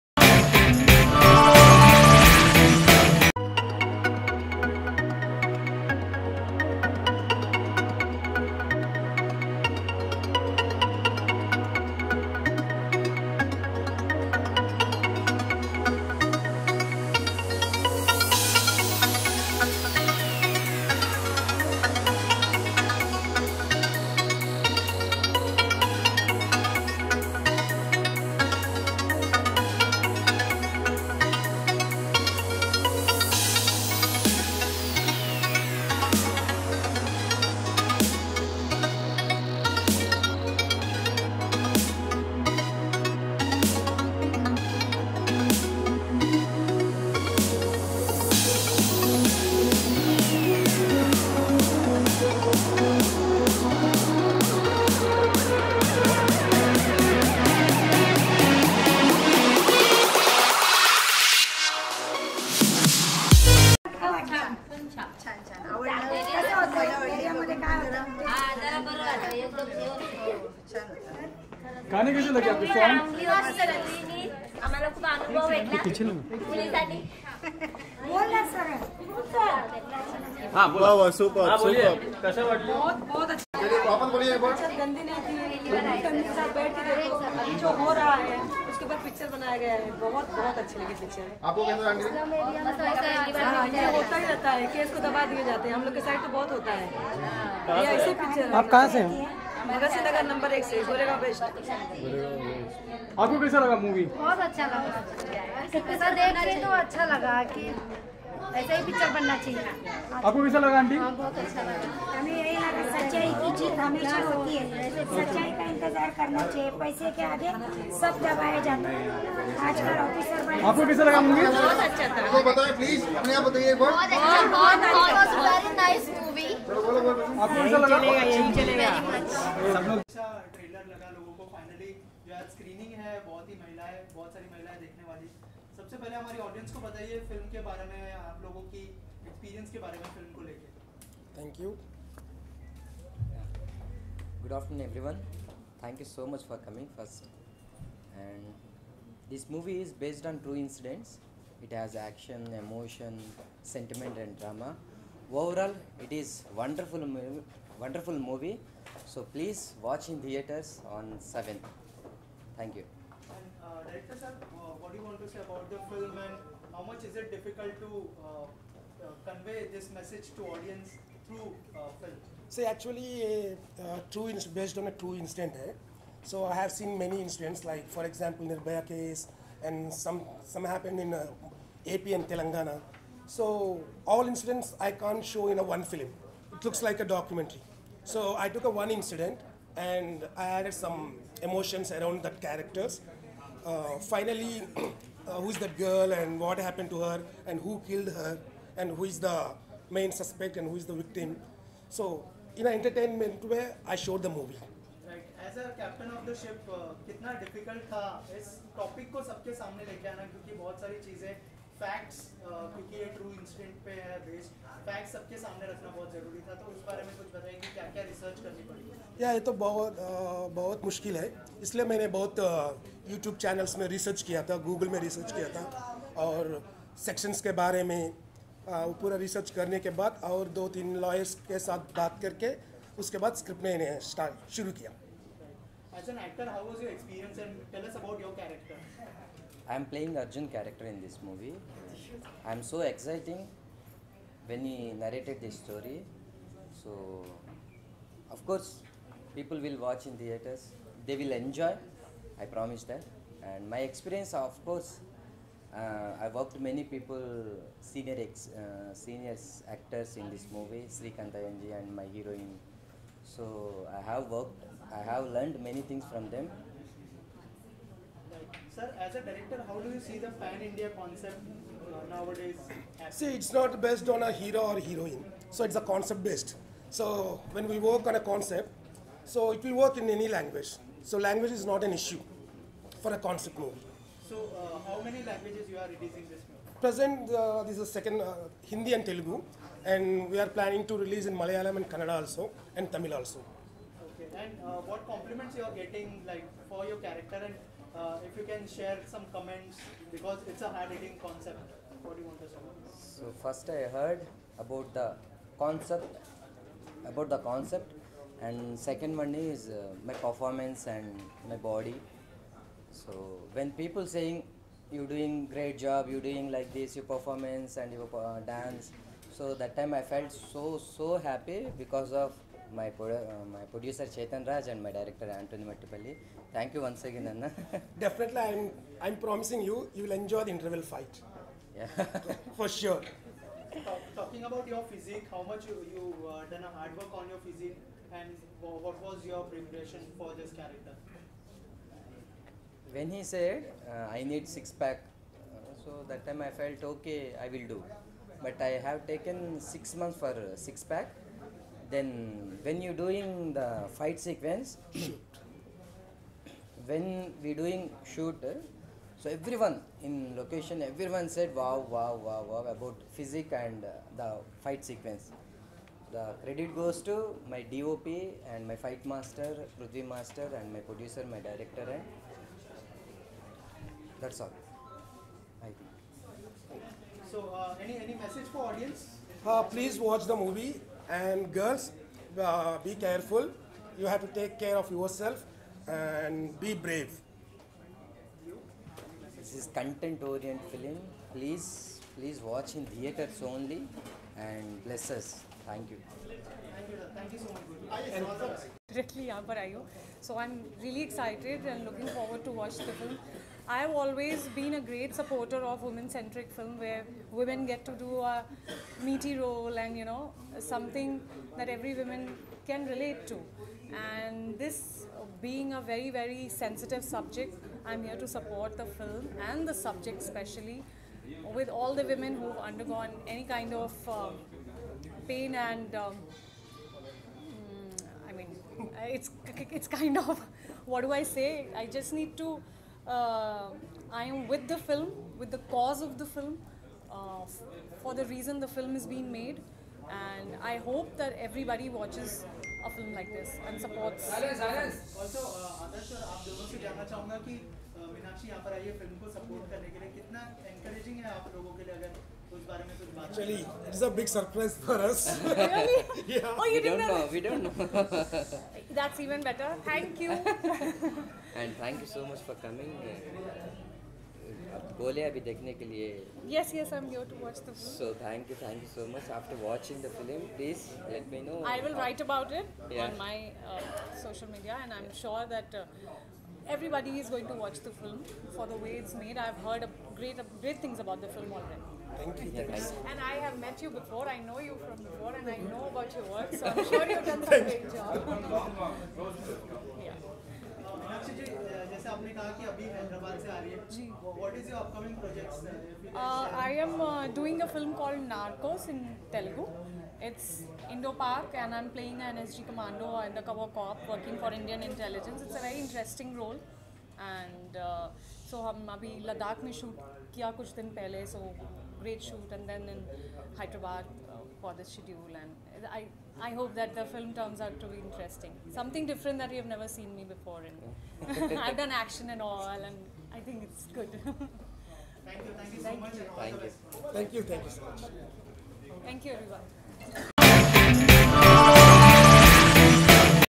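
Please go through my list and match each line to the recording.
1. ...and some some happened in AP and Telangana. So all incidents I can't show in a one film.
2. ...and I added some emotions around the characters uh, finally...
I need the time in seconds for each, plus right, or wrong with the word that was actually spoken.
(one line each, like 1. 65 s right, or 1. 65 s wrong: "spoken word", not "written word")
1. 179 s right
2. 189 s right.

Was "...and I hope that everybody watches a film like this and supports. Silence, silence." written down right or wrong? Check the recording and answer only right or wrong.
right.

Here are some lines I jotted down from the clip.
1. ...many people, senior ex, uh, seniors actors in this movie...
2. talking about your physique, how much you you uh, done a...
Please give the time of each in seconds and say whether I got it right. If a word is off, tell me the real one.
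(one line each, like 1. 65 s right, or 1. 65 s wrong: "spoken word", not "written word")
1. 256 s right
2. 334 s right.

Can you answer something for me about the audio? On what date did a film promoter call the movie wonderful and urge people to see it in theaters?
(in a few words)
7th.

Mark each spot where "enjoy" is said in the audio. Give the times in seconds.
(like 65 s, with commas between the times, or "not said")
251 s, 330 s.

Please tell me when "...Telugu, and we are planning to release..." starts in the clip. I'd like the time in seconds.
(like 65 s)
289 s.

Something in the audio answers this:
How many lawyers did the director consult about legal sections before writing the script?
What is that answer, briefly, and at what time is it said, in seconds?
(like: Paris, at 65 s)
2 or 3, at 230 s.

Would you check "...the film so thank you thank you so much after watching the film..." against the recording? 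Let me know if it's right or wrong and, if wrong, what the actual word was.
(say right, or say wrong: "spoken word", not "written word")
right.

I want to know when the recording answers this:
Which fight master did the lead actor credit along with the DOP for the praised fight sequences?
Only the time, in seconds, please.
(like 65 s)
369 s.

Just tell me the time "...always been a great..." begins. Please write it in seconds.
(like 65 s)
403 s.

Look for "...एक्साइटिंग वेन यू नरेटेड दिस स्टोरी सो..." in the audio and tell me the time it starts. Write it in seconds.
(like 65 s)
242 s.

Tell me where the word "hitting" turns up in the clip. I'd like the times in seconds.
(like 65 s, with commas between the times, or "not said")
300 s.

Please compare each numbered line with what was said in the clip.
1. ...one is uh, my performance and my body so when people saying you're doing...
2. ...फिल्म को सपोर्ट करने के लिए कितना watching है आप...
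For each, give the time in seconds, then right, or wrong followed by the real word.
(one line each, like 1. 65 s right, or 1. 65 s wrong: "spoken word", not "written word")
1. 309 s right
2. 448 s wrong: "encouraging", not "watching".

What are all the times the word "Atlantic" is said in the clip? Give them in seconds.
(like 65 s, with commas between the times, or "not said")
not said.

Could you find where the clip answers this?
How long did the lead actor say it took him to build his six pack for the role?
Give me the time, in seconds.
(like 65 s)
349 s.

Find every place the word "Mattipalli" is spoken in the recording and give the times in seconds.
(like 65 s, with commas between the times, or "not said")
325 s.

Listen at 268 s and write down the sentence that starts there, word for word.
Sir, as a director, how do you see the pan-India concept uh, nowadays?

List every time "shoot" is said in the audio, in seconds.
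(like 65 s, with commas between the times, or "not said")
358 s, 512 s.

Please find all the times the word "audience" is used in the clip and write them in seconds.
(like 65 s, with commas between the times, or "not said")
170 s, 378 s.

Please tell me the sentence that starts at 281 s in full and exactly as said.
So language is not an issue for a concept movie.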